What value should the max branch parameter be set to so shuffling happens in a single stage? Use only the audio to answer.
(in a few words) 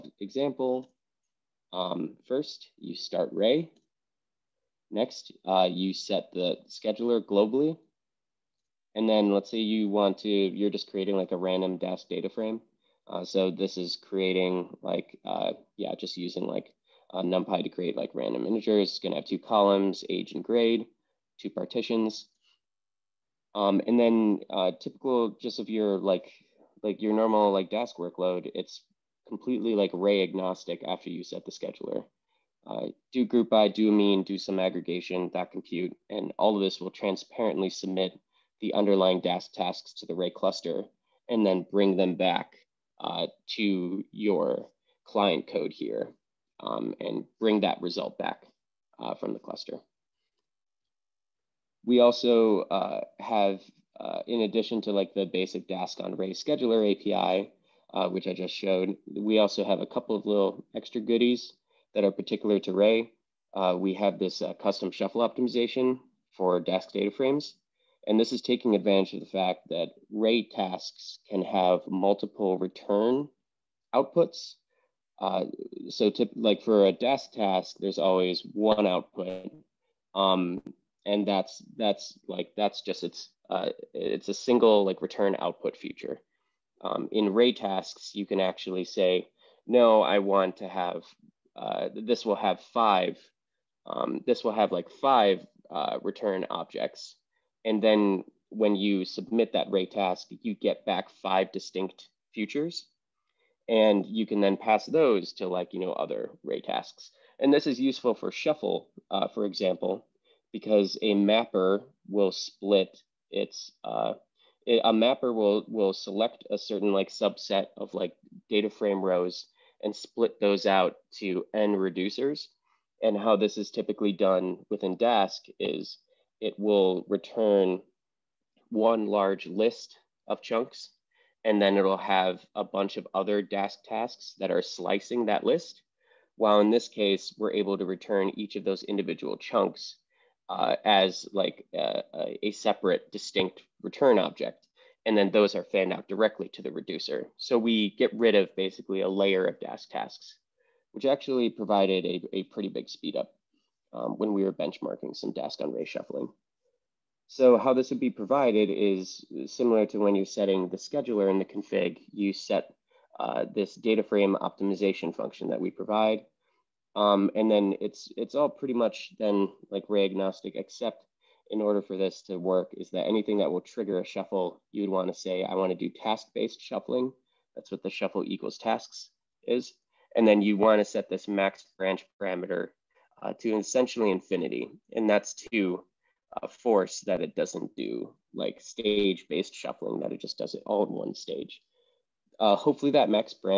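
infinity.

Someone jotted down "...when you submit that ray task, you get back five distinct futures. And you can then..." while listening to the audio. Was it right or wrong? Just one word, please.
right.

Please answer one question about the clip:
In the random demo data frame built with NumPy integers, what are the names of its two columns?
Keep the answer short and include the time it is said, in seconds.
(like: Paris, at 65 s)
age and grade, at 20 s.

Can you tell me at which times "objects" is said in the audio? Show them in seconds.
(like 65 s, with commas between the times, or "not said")
96 s, 144 s.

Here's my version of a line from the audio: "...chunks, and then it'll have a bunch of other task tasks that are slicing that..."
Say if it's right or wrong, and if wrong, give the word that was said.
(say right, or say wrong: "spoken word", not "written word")
right.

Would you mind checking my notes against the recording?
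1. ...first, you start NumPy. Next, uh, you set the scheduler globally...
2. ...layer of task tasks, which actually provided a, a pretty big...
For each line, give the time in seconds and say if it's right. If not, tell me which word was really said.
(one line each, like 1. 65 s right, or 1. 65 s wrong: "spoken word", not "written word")
1. 2 s wrong: "Ray", not "NumPy"
2. 149 s right.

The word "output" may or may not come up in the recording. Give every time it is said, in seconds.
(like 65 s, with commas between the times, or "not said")
73 s, 78 s, 85 s.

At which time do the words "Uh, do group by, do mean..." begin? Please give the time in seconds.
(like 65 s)
32 s.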